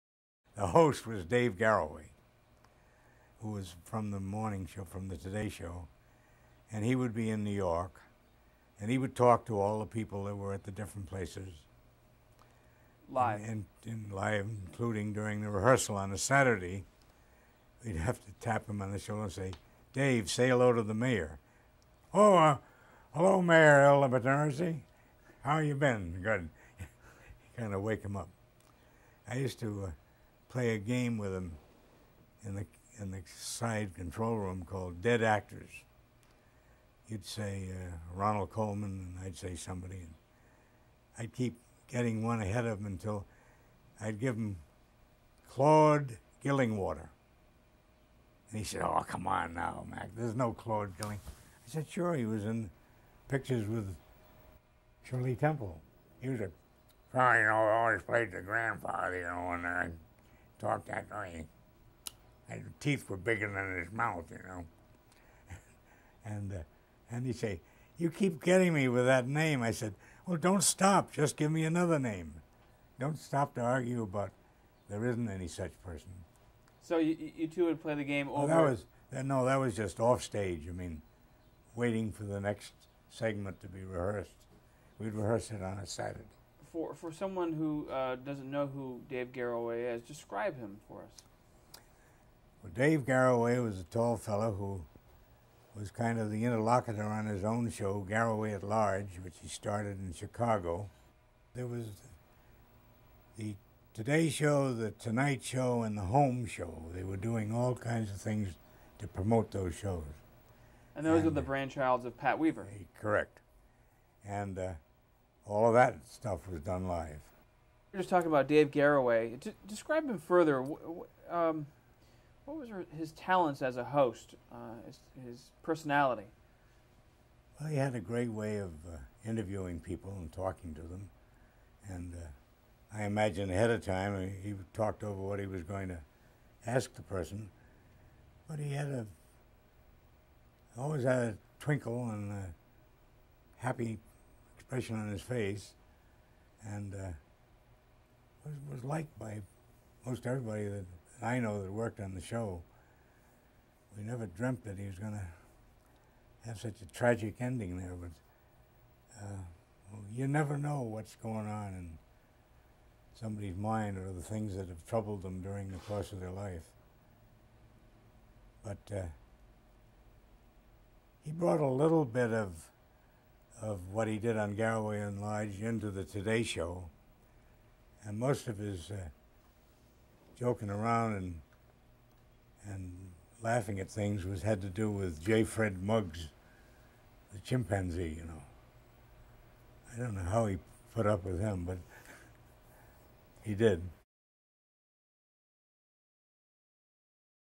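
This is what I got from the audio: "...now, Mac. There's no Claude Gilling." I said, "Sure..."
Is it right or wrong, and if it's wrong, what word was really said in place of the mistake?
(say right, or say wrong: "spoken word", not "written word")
right.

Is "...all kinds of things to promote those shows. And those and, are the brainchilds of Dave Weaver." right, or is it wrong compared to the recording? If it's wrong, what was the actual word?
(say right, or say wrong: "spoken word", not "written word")
wrong: "Pat", not "Dave".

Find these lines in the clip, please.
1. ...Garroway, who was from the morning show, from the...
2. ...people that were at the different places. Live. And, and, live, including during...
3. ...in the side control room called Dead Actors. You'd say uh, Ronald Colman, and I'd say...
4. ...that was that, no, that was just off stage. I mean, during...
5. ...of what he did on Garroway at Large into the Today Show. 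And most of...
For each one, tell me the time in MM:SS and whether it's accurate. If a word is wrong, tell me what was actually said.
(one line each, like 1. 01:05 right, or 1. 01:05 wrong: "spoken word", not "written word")
1. 00:01 right
2. 00:09 right
3. 00:32 right
4. 01:18 wrong: "waiting", not "during"
5. 02:53 right.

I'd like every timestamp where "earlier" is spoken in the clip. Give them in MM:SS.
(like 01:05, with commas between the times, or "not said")
not said.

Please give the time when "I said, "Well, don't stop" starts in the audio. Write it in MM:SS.
01:09.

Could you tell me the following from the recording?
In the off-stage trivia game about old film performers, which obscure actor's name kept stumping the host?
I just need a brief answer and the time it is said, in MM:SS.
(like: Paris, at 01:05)
Claude Gillingwater, at 00:45.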